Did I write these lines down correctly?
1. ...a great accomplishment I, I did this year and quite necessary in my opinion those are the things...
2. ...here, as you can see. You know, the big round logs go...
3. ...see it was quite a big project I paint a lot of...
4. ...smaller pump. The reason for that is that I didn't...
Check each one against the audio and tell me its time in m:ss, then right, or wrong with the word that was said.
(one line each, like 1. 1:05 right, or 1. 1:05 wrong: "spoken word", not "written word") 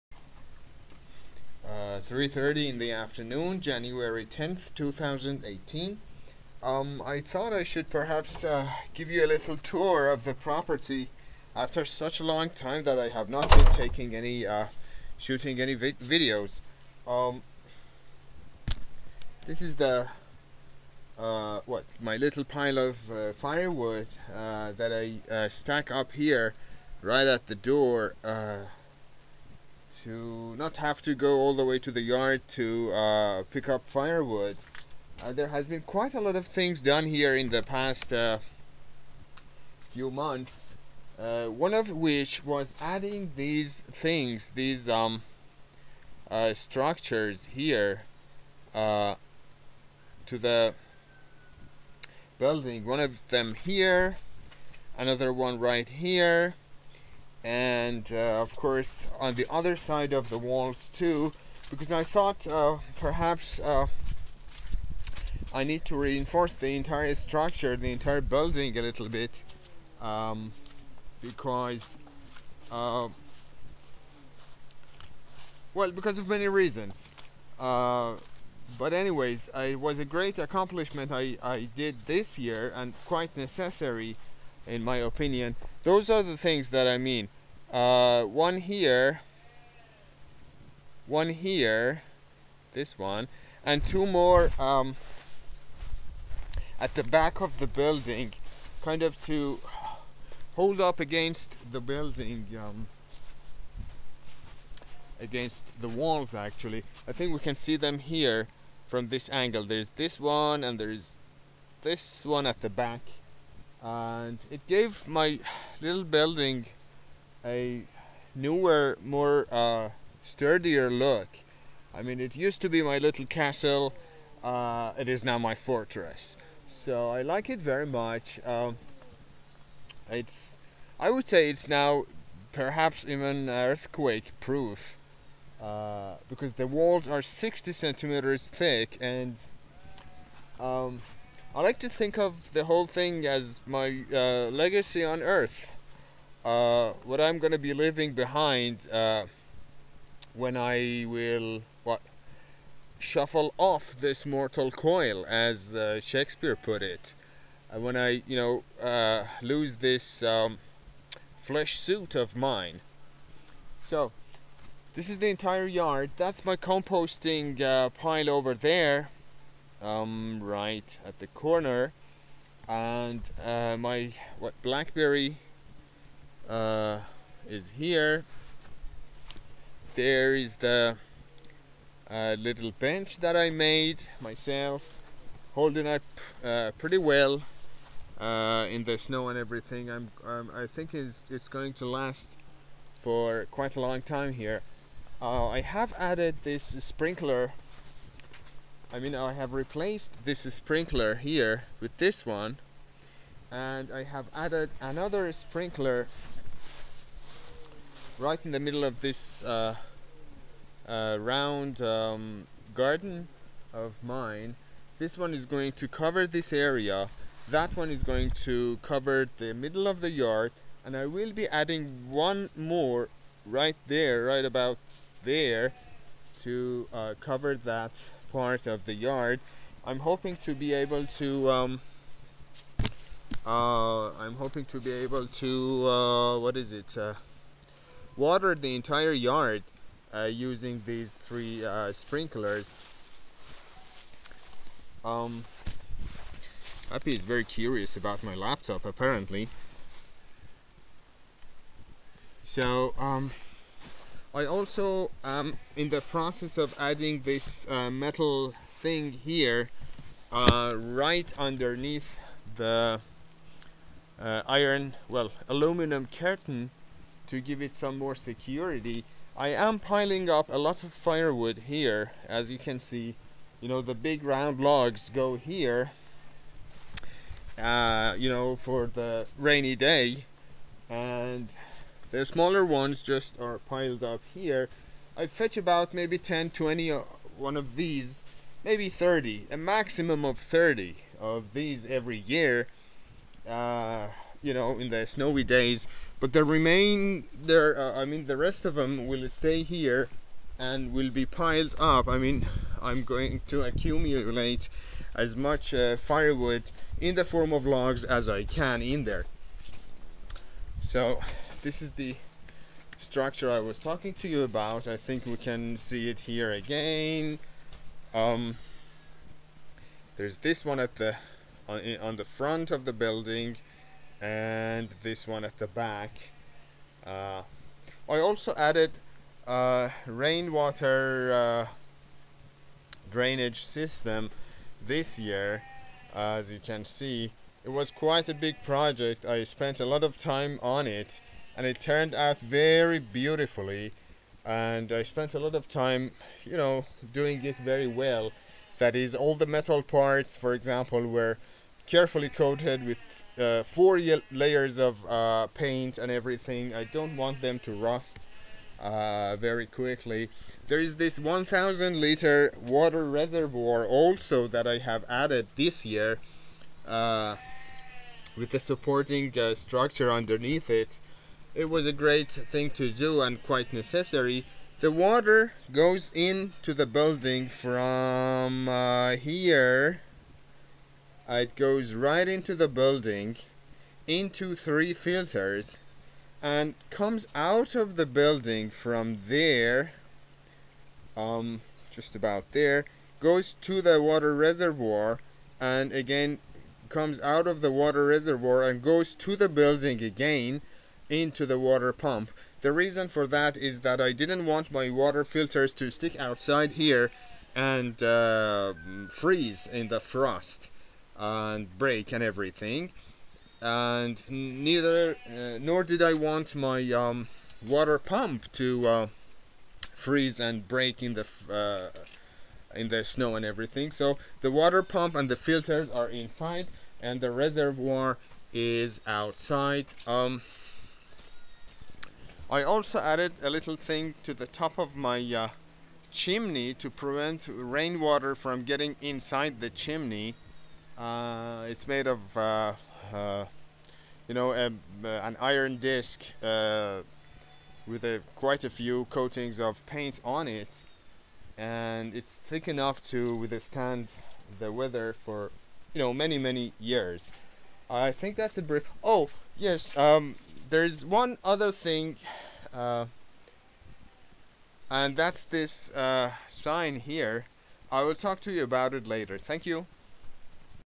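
1. 1:19 right
2. 4:31 right
3. 5:36 wrong: "spent", not "paint"
4. 6:41 wrong: "water", not "smaller".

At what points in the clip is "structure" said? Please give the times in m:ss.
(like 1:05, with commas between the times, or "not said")
0:46, 1:07, 5:12, 6:09.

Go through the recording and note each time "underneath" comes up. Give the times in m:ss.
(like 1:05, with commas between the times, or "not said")
4:21, 6:10.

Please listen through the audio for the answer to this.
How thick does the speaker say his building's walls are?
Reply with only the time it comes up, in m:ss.
2:17.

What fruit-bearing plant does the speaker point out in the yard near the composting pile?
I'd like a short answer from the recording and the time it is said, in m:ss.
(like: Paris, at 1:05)
blackberry, at 2:54.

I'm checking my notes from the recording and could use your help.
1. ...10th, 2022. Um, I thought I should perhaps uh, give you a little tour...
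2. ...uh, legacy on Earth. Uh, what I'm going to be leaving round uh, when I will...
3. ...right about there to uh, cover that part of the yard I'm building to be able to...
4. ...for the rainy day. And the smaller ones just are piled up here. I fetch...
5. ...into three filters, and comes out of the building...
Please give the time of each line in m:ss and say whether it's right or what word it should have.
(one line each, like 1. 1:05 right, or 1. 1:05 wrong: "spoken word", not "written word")
1. 0:04 wrong: "2018", not "2022"
2. 2:24 wrong: "behind", not "round"
3. 3:44 wrong: "hoping", not "building"
4. 4:38 right
5. 6:24 right.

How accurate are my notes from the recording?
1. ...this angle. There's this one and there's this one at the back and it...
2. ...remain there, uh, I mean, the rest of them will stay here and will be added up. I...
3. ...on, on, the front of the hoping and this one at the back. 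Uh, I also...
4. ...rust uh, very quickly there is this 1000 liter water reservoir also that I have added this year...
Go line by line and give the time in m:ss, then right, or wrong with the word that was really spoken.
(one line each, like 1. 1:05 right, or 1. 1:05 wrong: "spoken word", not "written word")
1. 1:49 right
2. 4:56 wrong: "piled", not "added"
3. 5:21 wrong: "building", not "hoping"
4. 5:57 right.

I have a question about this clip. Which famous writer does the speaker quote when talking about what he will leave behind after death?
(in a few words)
Shakespeare.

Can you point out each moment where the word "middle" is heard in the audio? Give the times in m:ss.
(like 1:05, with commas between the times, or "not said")
3:28, 3:39.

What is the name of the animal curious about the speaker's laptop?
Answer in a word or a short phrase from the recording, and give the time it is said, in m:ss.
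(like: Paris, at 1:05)
Happy, at 4:06.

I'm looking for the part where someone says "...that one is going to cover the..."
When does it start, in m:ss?
3:37.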